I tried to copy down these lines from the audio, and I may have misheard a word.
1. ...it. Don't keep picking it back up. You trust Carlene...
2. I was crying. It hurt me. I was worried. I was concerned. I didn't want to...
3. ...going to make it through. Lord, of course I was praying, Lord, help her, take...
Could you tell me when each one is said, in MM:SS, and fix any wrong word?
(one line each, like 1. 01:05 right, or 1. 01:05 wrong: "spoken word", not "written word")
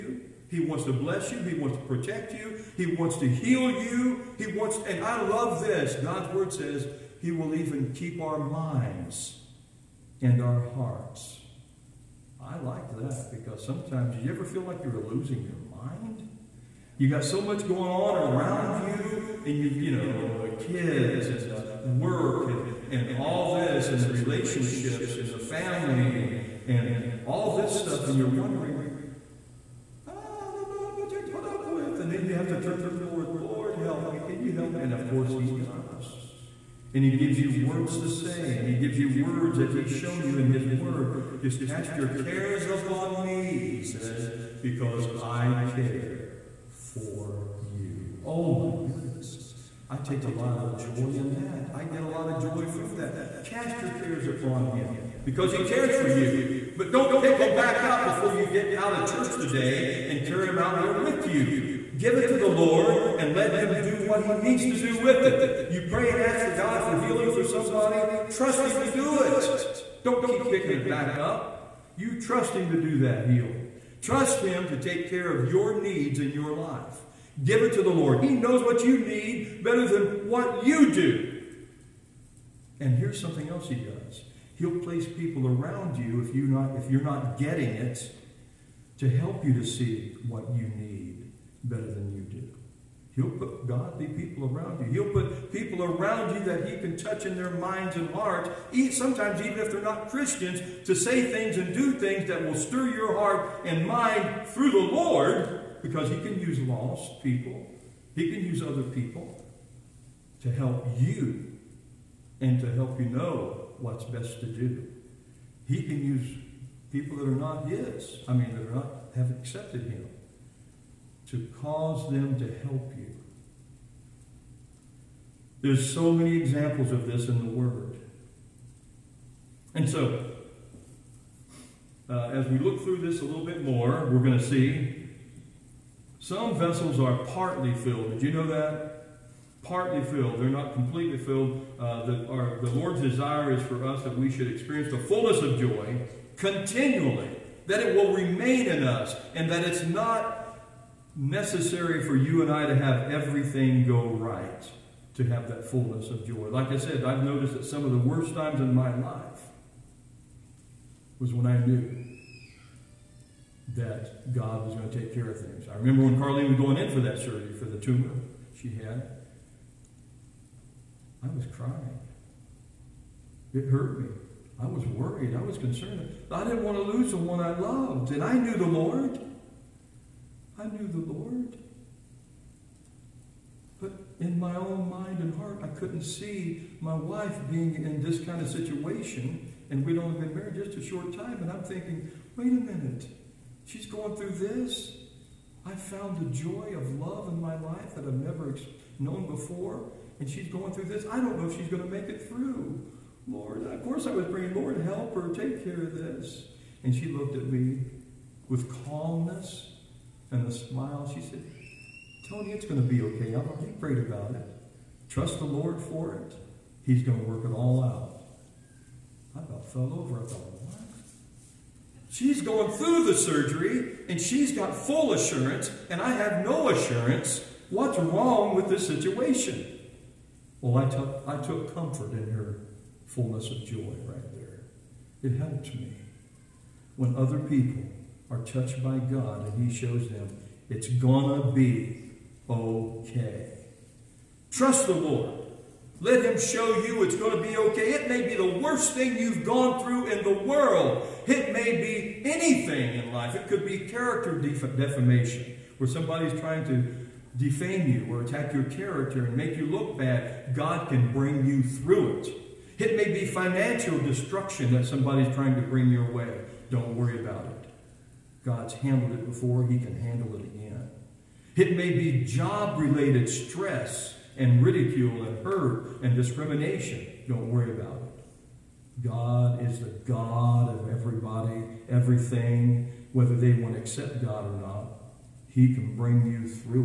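1. 01:09 wrong: "Him", not "Carlene"
2. 02:51 right
3. 03:21 right.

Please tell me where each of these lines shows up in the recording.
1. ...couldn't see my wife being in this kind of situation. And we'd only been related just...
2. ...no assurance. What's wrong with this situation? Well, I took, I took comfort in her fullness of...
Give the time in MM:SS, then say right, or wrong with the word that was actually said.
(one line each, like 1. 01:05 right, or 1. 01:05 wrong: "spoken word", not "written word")
1. 03:05 wrong: "married", not "related"
2. 03:46 right.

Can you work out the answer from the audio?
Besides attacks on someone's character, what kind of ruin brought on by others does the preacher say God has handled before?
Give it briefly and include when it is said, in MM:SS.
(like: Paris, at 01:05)
Financial destruction, at 04:23.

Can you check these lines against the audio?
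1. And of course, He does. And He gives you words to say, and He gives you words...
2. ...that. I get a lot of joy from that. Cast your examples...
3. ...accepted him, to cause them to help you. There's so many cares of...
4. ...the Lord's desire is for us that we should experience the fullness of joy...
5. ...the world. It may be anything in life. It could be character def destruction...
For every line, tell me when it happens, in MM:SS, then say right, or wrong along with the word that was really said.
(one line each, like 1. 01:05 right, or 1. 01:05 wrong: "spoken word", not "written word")
1. 00:34 right
2. 00:51 wrong: "cares", not "examples"
3. 01:59 wrong: "examples", not "cares"
4. 02:22 right
5. 04:10 wrong: "defamation", not "destruction".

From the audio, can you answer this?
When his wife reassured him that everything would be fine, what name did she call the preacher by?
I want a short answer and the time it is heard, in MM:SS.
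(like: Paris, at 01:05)
Tony, at 03:32.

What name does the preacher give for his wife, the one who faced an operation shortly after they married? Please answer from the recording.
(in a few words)
Carlene.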